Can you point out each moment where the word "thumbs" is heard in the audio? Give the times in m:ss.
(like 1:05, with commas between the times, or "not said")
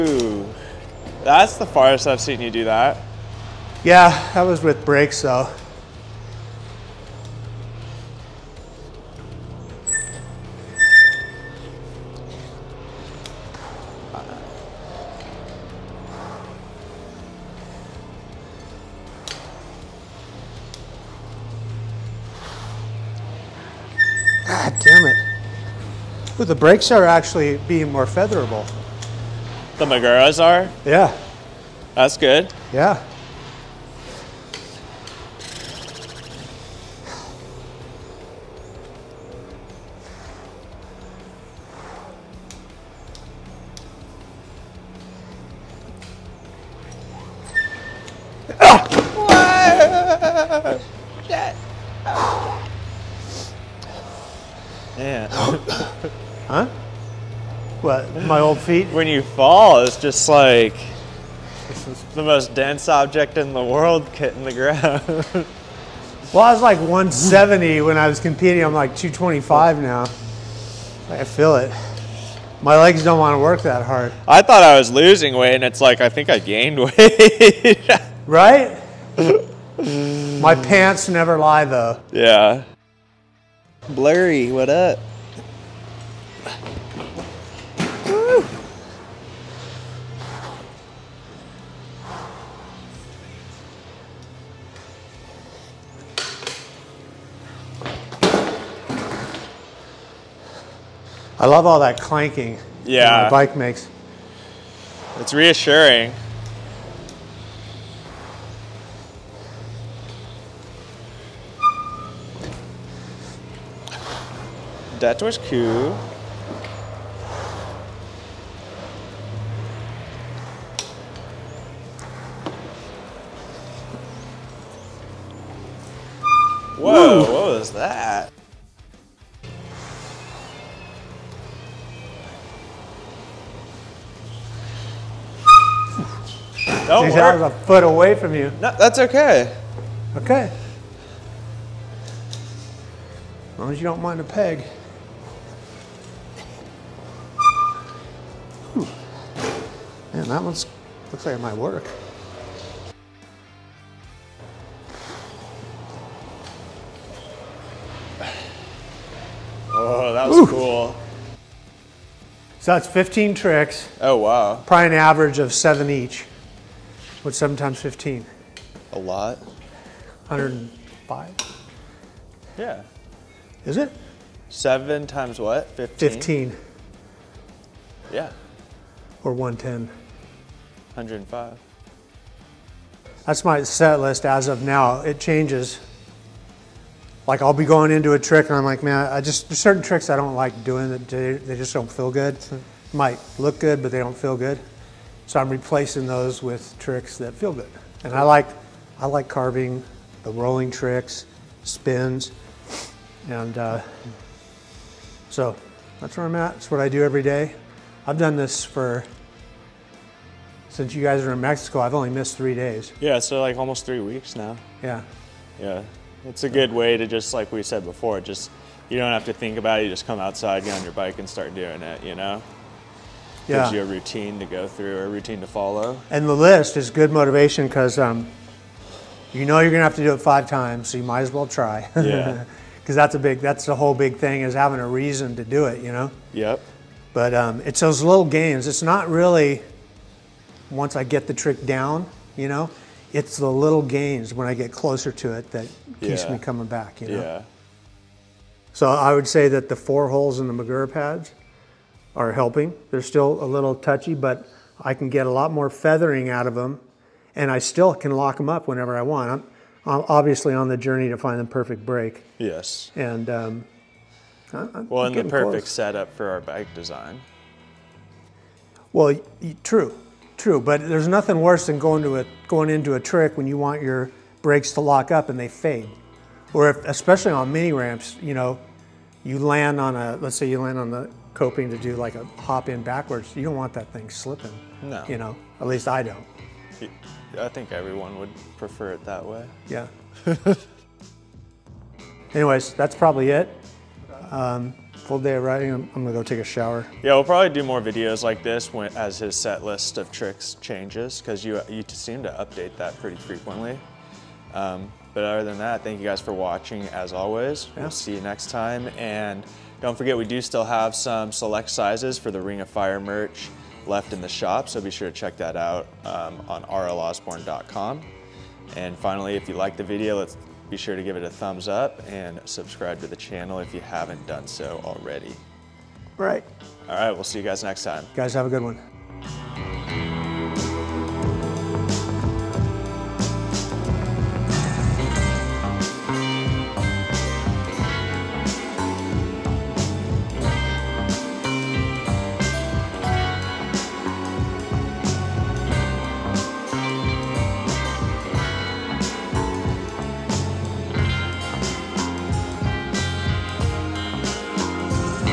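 5:21.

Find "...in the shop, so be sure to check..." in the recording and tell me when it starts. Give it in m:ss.
5:14.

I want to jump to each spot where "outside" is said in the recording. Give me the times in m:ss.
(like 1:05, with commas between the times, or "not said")
3:40.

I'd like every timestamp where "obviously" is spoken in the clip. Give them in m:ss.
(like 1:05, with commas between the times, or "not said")
4:20.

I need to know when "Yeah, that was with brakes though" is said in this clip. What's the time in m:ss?
0:03.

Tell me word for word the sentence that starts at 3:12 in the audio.
Might look good, but they don't feel good.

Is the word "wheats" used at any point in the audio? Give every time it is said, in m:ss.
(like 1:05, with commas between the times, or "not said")
not said.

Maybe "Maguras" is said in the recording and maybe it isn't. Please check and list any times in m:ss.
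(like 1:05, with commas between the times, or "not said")
0:29, 4:10.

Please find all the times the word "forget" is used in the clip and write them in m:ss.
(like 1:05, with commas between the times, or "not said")
5:09.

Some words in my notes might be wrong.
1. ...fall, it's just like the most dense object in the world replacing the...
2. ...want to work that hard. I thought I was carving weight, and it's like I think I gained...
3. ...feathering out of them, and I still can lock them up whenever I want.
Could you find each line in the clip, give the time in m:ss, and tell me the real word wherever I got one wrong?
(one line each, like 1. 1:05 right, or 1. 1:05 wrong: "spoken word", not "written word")
1. 0:59 wrong: "hitting", not "replacing"
2. 1:13 wrong: "losing", not "carving"
3. 4:15 right.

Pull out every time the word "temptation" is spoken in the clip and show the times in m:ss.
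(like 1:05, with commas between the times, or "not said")
not said.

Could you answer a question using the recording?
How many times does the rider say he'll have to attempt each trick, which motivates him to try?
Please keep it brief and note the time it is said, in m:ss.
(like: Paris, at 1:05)
5 times, at 3:50.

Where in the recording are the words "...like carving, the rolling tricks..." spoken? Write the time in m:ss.
3:19.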